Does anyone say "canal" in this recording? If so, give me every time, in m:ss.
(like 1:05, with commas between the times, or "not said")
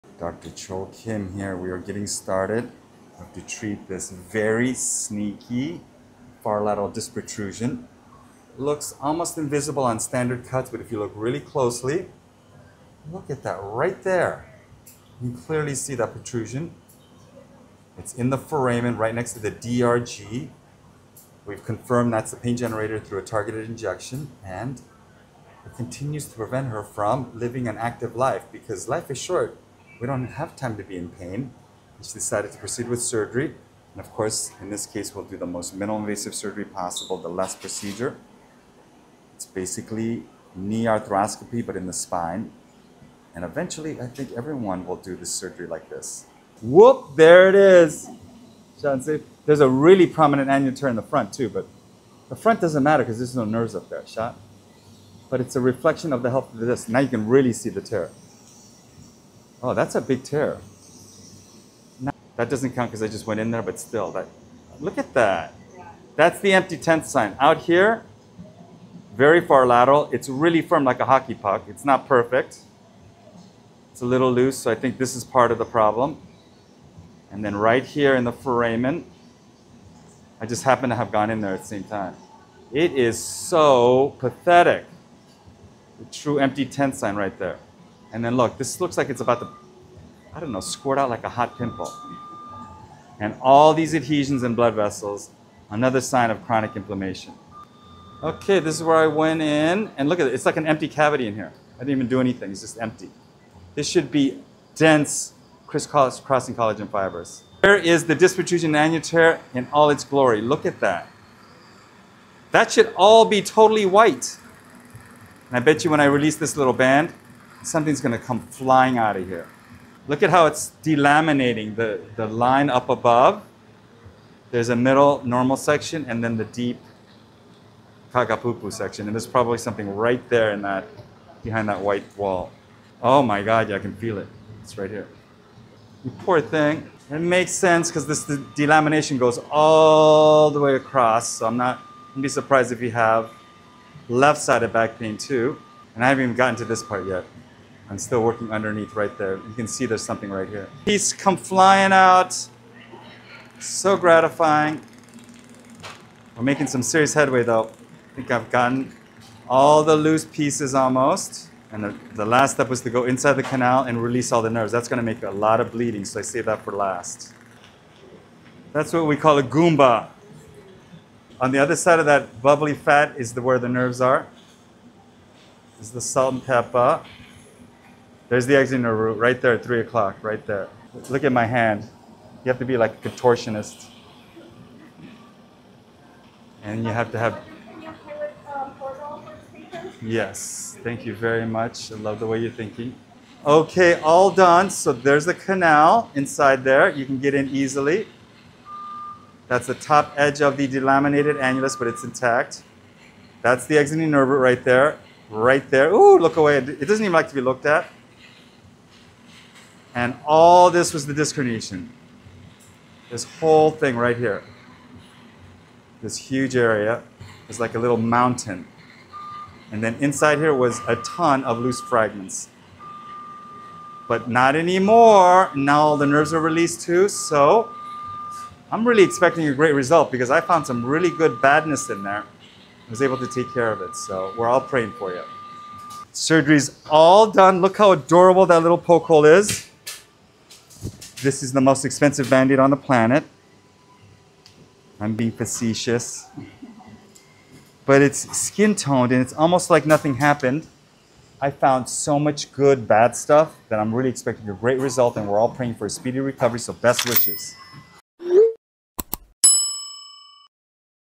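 2:43, 3:15.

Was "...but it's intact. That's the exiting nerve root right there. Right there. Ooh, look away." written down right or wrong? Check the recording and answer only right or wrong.
right.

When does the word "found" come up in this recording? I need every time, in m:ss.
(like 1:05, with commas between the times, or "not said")
3:50, 4:11.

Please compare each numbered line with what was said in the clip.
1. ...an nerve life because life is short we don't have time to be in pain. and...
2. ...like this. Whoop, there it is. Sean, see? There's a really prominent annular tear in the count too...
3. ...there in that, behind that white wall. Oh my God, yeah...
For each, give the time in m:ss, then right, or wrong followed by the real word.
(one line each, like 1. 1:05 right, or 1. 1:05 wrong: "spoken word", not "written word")
1. 0:27 wrong: "active", not "nerve"
2. 0:45 wrong: "front", not "count"
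3. 2:10 right.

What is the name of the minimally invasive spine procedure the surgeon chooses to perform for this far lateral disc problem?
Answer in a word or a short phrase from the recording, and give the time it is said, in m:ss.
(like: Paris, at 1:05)
LESS procedure, at 0:37.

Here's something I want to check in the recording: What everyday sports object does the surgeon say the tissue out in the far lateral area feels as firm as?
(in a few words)
Hockey puck.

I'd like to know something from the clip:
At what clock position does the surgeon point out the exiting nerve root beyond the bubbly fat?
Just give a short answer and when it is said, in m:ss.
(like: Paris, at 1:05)
3 o'clock, at 2:59.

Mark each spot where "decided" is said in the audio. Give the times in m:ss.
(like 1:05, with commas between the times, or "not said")
0:32.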